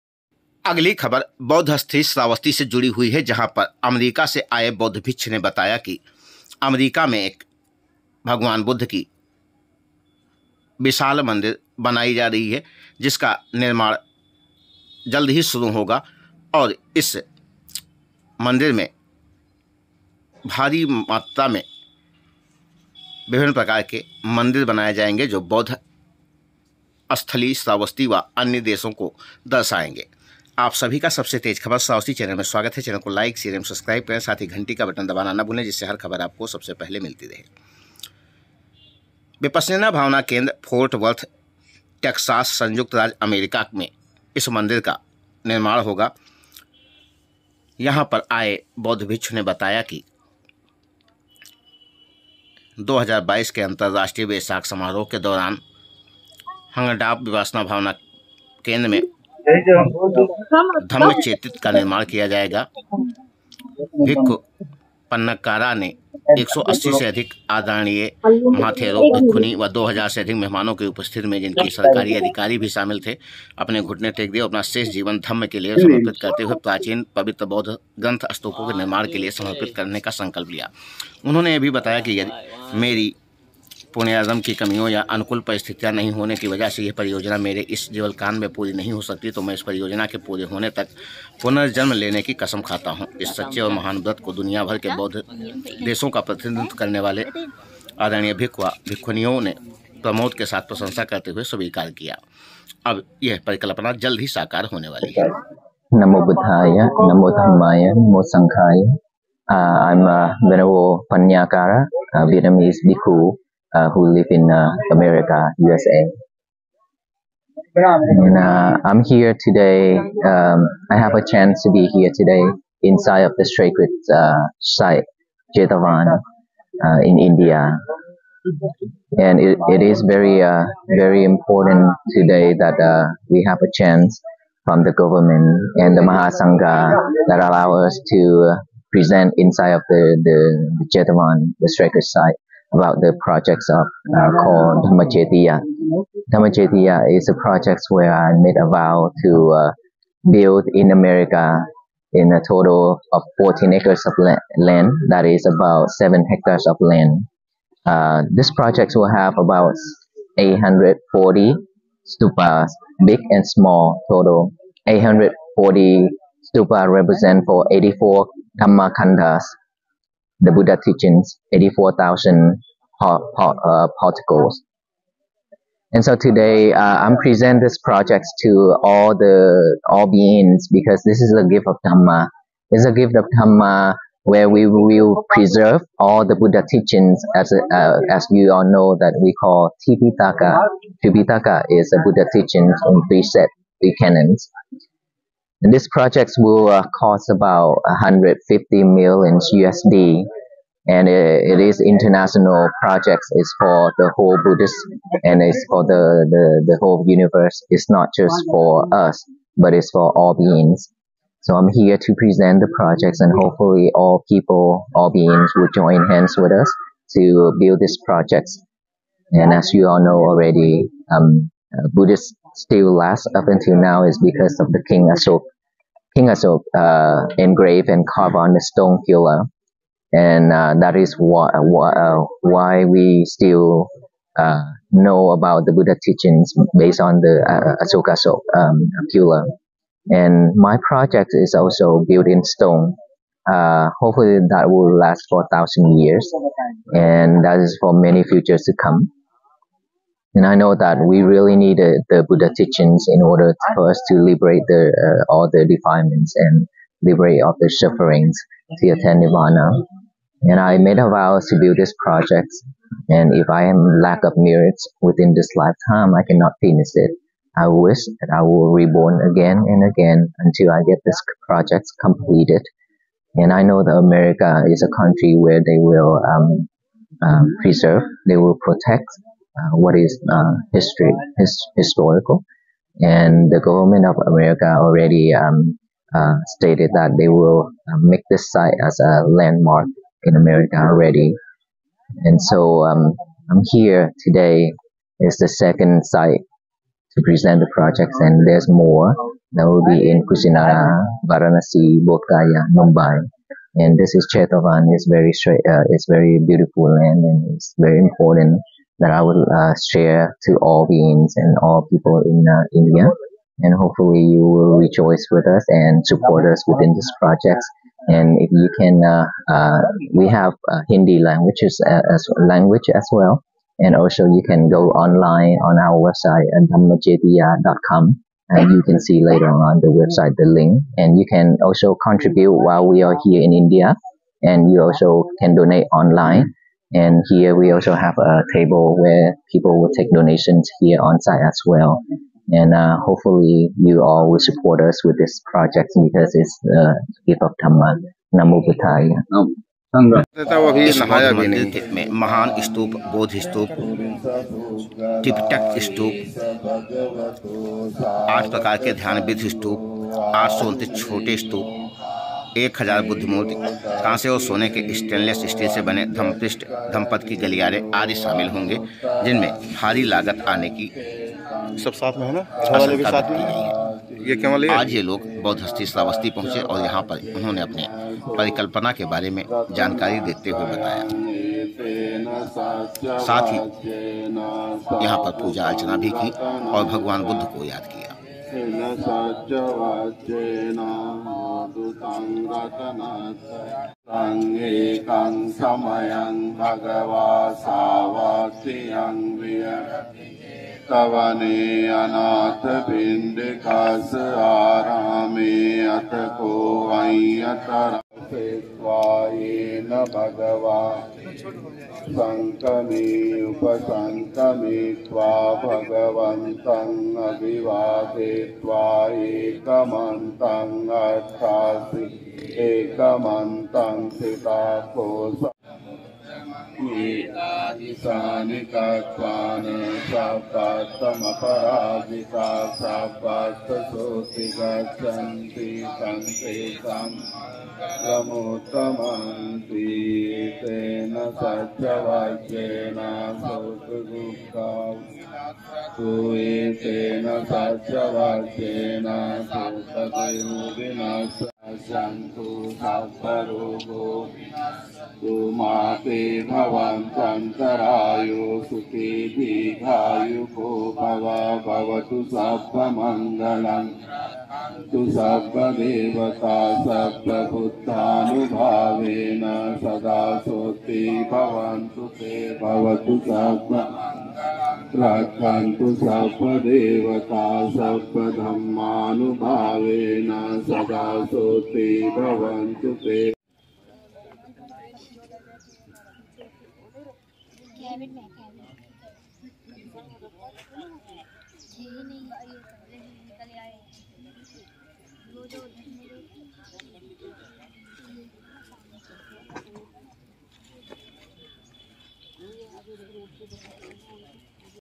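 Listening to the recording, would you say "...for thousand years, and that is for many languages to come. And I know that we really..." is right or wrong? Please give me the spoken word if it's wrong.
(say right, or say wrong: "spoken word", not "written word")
wrong: "futures", not "languages".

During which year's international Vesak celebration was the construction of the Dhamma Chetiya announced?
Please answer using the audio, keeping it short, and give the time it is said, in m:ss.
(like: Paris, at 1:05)
2022, at 0:52.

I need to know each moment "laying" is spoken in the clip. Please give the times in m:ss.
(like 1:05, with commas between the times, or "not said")
not said.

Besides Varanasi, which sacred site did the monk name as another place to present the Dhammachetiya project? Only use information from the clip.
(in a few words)
Kusinara.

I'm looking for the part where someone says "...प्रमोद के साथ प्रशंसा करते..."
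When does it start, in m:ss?
1:40.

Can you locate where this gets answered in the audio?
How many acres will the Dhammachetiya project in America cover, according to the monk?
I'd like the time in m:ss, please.
2:33.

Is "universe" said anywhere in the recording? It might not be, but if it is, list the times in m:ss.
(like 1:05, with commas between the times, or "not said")
3:27.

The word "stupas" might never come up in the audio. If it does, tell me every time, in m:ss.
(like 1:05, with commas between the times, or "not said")
2:42, 2:46.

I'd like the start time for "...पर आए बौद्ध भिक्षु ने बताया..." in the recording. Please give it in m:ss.
0:48.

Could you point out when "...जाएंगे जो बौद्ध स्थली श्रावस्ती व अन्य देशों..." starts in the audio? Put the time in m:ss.
0:24.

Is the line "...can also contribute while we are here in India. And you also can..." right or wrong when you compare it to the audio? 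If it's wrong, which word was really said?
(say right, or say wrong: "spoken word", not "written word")
right.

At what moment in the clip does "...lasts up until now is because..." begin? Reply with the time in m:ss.
3:42.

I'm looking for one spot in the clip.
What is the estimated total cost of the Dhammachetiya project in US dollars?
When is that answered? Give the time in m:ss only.
3:17.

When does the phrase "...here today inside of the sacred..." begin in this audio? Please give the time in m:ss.
2:01.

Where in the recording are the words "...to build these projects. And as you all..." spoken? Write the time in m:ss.
3:37.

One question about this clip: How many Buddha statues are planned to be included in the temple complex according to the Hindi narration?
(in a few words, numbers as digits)
1,000.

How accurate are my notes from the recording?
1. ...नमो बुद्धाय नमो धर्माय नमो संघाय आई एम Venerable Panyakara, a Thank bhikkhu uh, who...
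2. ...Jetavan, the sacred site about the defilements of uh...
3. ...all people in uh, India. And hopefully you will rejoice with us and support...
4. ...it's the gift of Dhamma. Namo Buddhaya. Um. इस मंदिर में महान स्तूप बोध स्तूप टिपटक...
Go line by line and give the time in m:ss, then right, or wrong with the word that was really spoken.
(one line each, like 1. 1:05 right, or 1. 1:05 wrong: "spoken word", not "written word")
1. 1:46 wrong: "Vietnamese", not "Thank"
2. 2:20 wrong: "projects", not "defilements"
3. 5:11 right
4. 5:46 right.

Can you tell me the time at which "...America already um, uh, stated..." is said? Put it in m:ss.
4:44.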